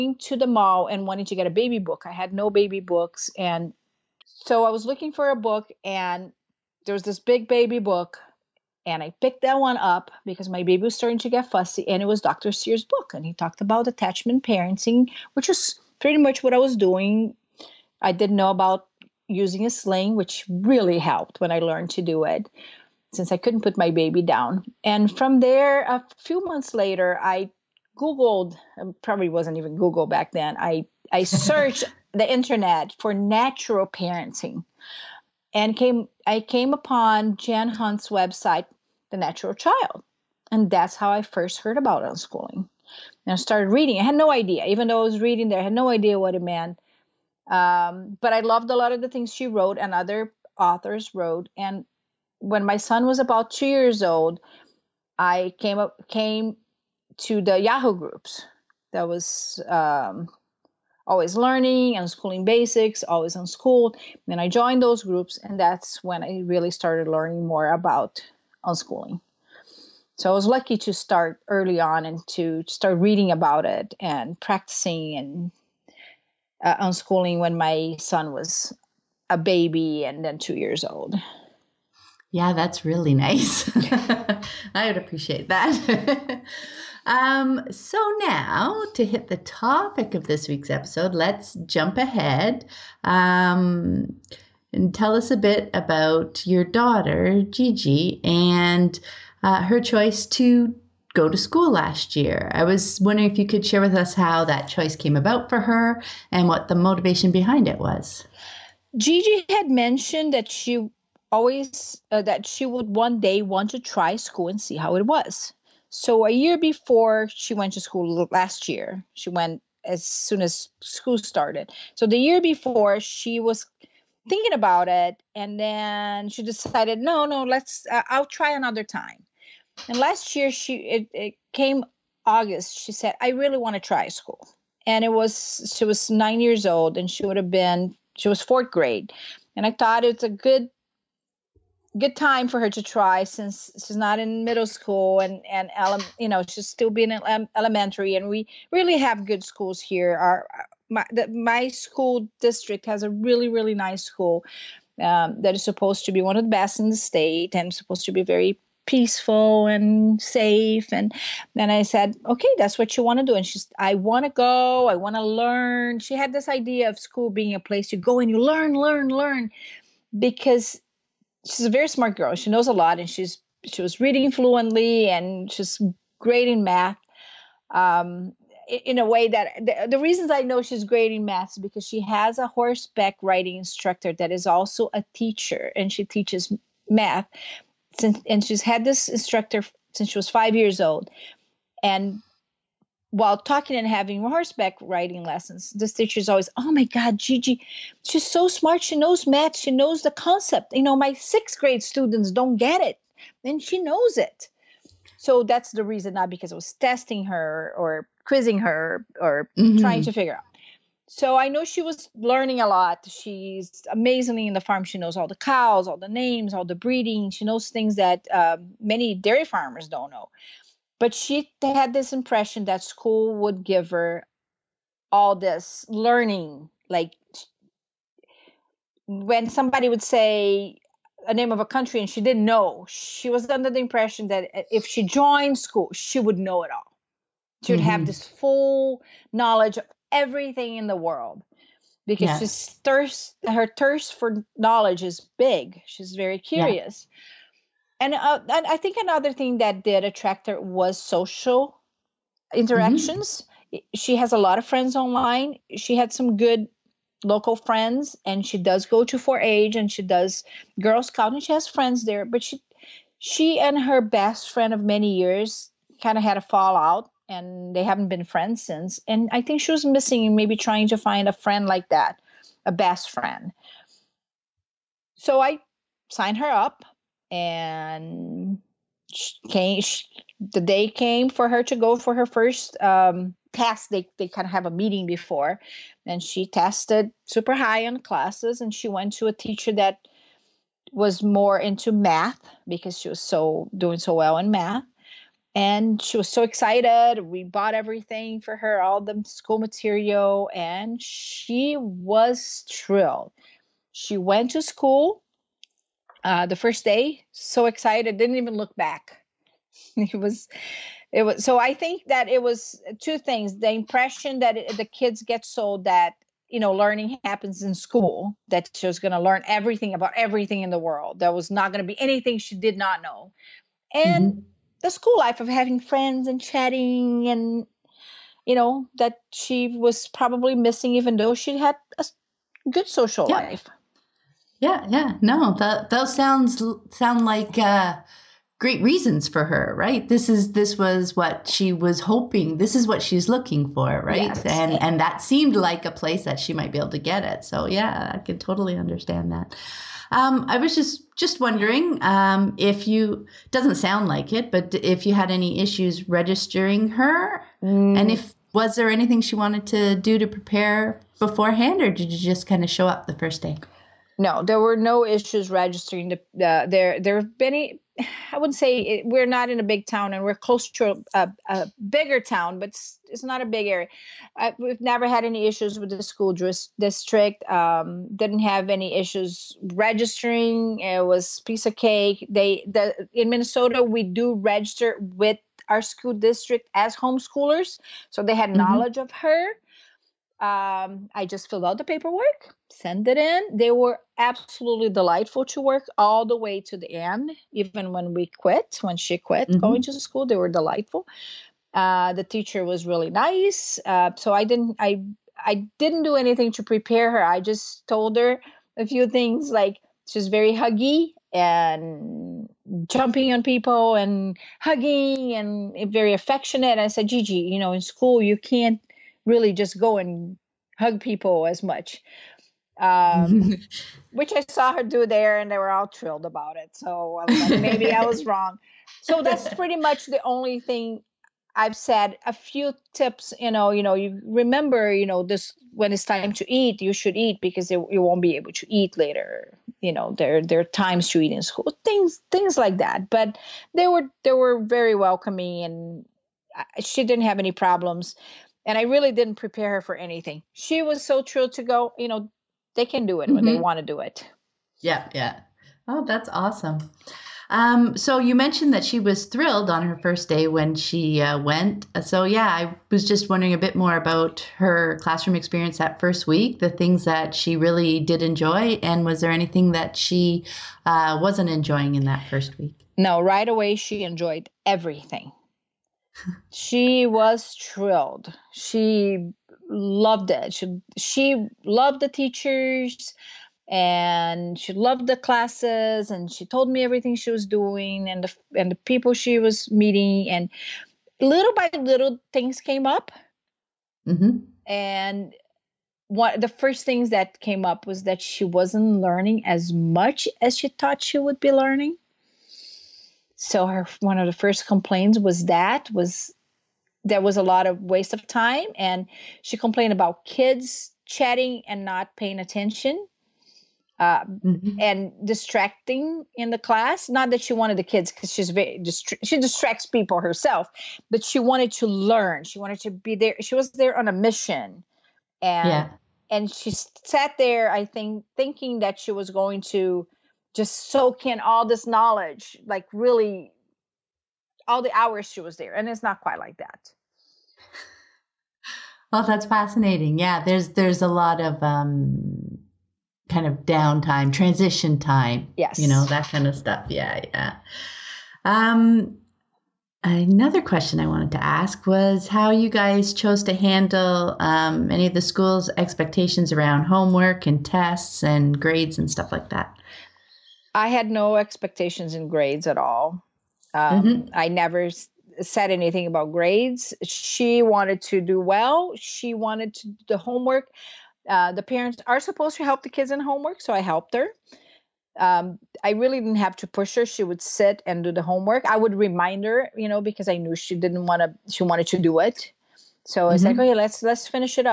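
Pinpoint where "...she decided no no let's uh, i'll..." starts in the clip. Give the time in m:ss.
2:06.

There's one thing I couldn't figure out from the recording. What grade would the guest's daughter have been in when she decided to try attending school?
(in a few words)
fourth grade.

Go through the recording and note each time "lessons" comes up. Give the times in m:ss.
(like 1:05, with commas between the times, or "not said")
3:15.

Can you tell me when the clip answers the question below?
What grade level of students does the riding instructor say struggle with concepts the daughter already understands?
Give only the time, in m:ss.
3:21.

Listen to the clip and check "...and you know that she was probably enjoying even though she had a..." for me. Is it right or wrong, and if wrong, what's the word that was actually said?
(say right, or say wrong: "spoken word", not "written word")
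wrong: "missing", not "enjoying".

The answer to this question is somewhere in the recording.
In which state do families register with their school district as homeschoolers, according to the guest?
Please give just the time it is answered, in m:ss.
6:23.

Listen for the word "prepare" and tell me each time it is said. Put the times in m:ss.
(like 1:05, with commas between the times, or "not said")
6:00, 6:46, 7:29.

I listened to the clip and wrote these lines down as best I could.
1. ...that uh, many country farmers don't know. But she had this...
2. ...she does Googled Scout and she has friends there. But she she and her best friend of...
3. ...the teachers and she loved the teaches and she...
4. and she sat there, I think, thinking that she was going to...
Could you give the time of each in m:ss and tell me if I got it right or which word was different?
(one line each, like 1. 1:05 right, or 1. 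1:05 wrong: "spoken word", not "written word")
1. 3:37 wrong: "dairy", not "country"
2. 4:19 wrong: "Girl", not "Googled"
3. 8:01 wrong: "classes", not "teaches"
4. 8:46 right.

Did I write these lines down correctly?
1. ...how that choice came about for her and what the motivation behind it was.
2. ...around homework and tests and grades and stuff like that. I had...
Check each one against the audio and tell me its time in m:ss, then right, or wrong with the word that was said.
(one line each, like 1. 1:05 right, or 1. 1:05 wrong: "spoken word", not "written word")
1. 1:44 right
2. 9:16 right.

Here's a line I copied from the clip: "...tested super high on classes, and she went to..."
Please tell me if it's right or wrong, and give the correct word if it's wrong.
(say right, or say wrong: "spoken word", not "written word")
right.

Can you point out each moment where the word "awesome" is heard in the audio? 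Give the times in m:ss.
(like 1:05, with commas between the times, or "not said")
7:36.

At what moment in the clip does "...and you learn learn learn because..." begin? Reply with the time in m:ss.
2:48.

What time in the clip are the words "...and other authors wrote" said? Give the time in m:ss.
0:49.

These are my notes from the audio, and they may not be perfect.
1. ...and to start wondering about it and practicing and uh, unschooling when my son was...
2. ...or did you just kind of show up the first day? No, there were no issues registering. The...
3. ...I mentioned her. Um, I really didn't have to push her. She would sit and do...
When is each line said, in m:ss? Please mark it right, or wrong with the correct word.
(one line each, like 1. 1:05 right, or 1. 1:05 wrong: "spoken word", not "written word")
1. 1:12 wrong: "reading", not "wondering"
2. 6:01 right
3. 9:33 wrong: "helped", not "mentioned".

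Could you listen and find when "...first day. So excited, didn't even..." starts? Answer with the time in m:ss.
5:06.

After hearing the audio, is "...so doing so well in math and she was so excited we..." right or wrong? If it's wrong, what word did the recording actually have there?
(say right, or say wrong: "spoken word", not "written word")
right.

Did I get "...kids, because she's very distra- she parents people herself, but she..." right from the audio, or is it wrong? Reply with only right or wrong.
wrong.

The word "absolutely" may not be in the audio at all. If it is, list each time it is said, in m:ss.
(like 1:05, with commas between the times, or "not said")
6:34.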